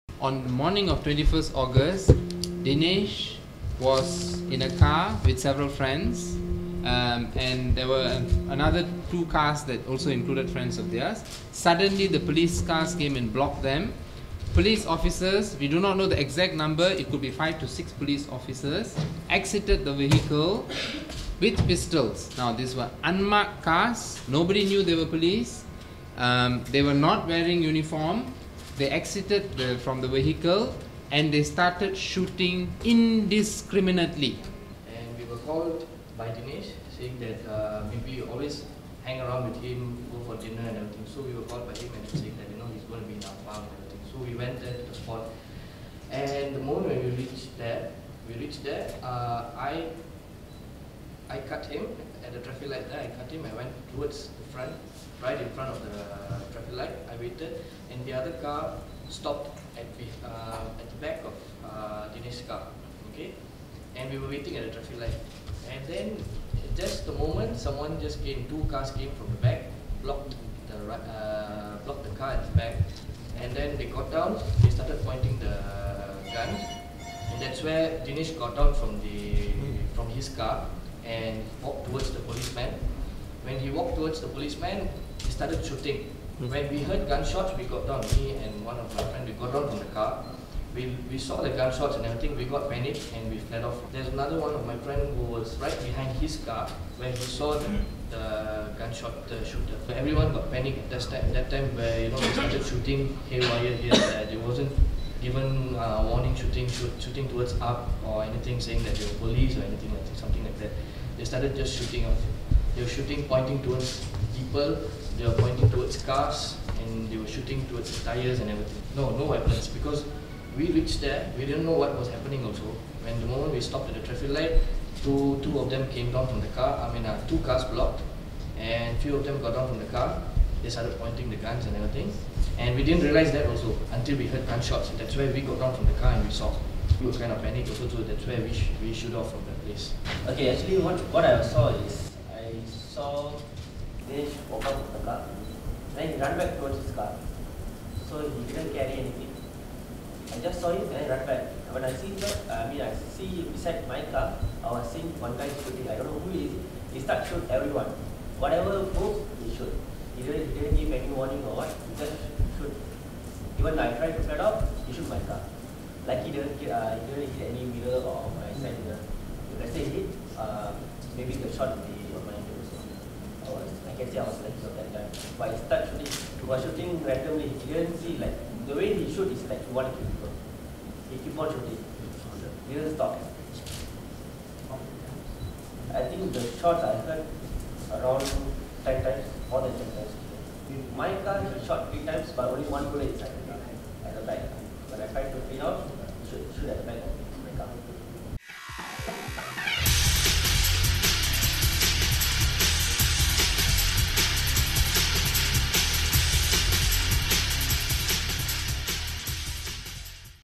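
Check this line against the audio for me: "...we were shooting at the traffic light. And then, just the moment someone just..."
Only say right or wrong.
wrong.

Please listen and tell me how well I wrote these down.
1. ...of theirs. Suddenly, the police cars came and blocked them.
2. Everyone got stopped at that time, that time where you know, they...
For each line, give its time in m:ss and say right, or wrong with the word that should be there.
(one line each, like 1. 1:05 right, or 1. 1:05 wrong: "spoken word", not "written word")
1. 0:10 right
2. 1:39 wrong: "panicked", not "stopped".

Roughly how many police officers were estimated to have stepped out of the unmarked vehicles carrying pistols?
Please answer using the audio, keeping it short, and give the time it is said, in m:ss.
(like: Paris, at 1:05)
5 to 6, at 0:17.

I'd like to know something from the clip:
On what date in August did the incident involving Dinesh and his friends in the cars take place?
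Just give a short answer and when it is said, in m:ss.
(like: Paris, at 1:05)
21st August, at 0:01.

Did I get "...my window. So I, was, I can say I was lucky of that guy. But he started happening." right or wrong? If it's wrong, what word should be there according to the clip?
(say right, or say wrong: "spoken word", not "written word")
wrong: "shooting", not "happening".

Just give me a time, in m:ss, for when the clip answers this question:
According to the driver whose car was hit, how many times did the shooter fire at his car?
3:11.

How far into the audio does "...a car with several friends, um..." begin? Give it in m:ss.
0:04.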